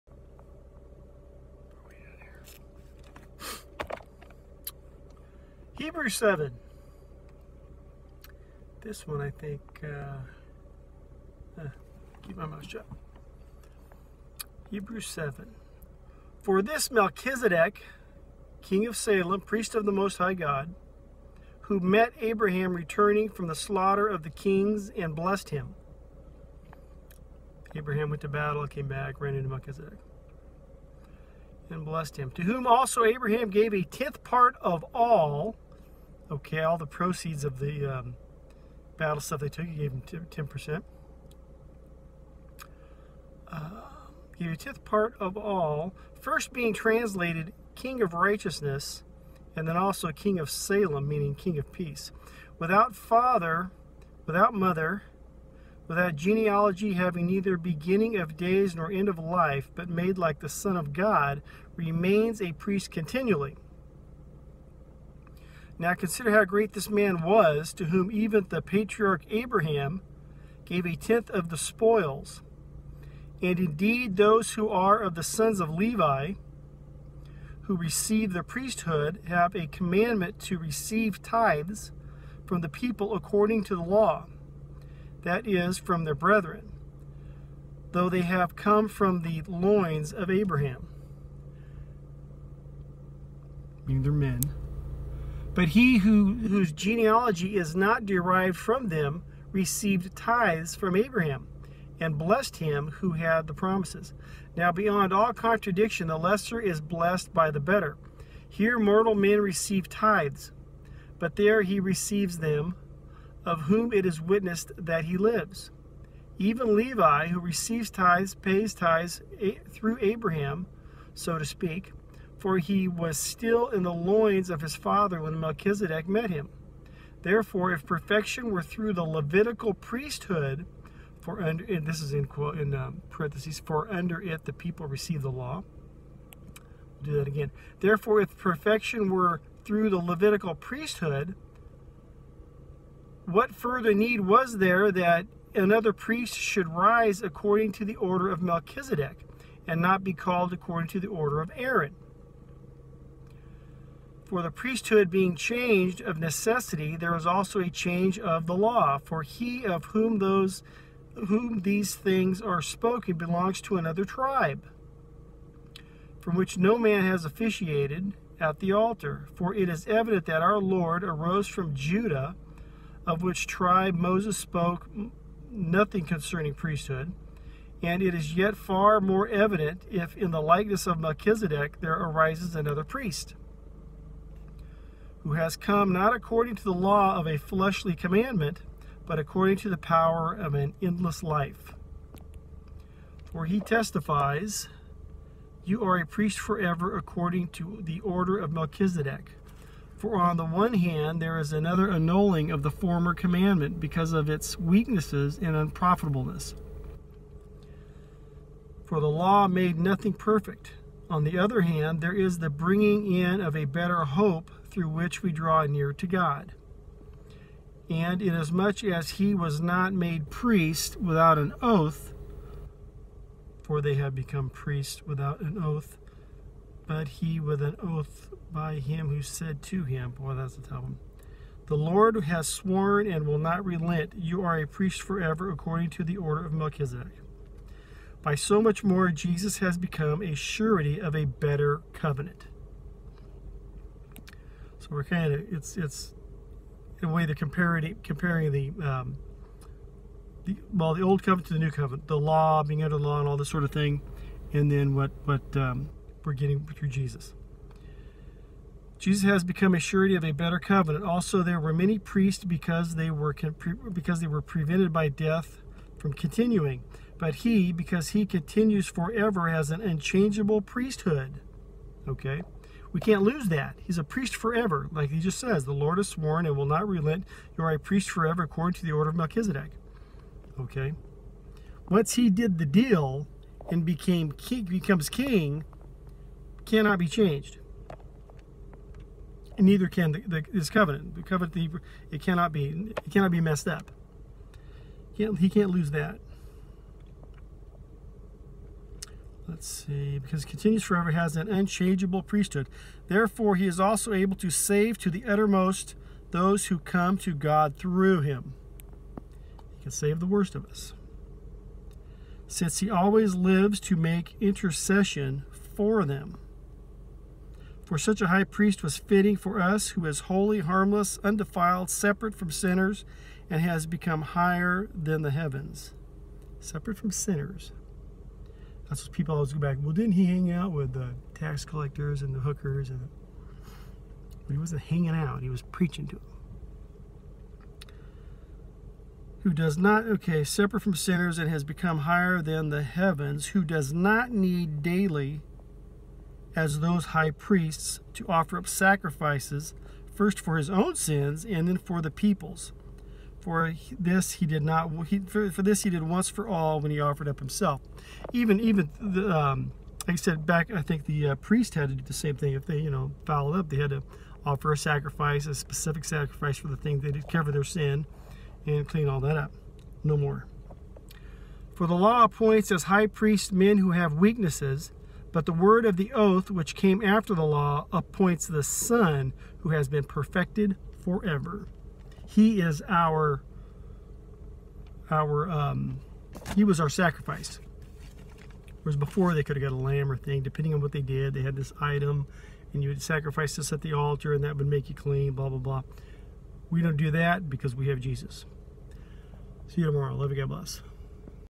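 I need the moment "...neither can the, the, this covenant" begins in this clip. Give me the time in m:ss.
4:49.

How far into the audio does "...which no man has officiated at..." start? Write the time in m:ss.
2:46.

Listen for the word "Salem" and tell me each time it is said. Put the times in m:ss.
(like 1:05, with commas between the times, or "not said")
0:18, 0:50.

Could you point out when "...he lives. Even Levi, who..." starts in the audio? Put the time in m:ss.
1:55.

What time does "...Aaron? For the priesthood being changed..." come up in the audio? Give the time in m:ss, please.
2:31.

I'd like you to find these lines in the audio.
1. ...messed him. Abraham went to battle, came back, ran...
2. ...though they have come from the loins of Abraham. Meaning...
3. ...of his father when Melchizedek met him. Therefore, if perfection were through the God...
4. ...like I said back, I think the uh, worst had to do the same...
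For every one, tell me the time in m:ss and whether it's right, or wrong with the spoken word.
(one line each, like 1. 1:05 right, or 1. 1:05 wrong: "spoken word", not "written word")
1. 0:25 wrong: "blessed", not "messed"
2. 1:27 right
3. 2:04 wrong: "Levitical", not "God"
4. 6:00 wrong: "priest", not "worst".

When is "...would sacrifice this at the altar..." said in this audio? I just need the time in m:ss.
6:32.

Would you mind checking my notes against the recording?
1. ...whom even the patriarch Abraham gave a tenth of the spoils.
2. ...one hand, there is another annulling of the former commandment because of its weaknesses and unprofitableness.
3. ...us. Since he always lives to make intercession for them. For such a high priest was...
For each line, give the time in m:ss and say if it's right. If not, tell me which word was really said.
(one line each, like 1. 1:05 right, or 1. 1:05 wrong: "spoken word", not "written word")
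1. 1:07 right
2. 3:20 right
3. 5:10 right.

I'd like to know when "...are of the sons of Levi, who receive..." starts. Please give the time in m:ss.
1:14.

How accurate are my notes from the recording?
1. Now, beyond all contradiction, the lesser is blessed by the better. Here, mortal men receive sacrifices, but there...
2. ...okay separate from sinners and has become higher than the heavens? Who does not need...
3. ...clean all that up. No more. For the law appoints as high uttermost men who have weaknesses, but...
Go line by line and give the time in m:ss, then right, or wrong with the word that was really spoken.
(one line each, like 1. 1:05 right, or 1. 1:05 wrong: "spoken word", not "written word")
1. 1:44 wrong: "tithes", not "sacrifices"
2. 5:40 right
3. 6:08 wrong: "priest", not "uttermost".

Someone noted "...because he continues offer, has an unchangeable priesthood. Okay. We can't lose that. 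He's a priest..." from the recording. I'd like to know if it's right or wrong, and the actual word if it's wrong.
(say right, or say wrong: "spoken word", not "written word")
wrong: "forever", not "offer".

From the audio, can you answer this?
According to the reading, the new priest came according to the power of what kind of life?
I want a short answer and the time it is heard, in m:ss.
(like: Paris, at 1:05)
An endless life, at 3:10.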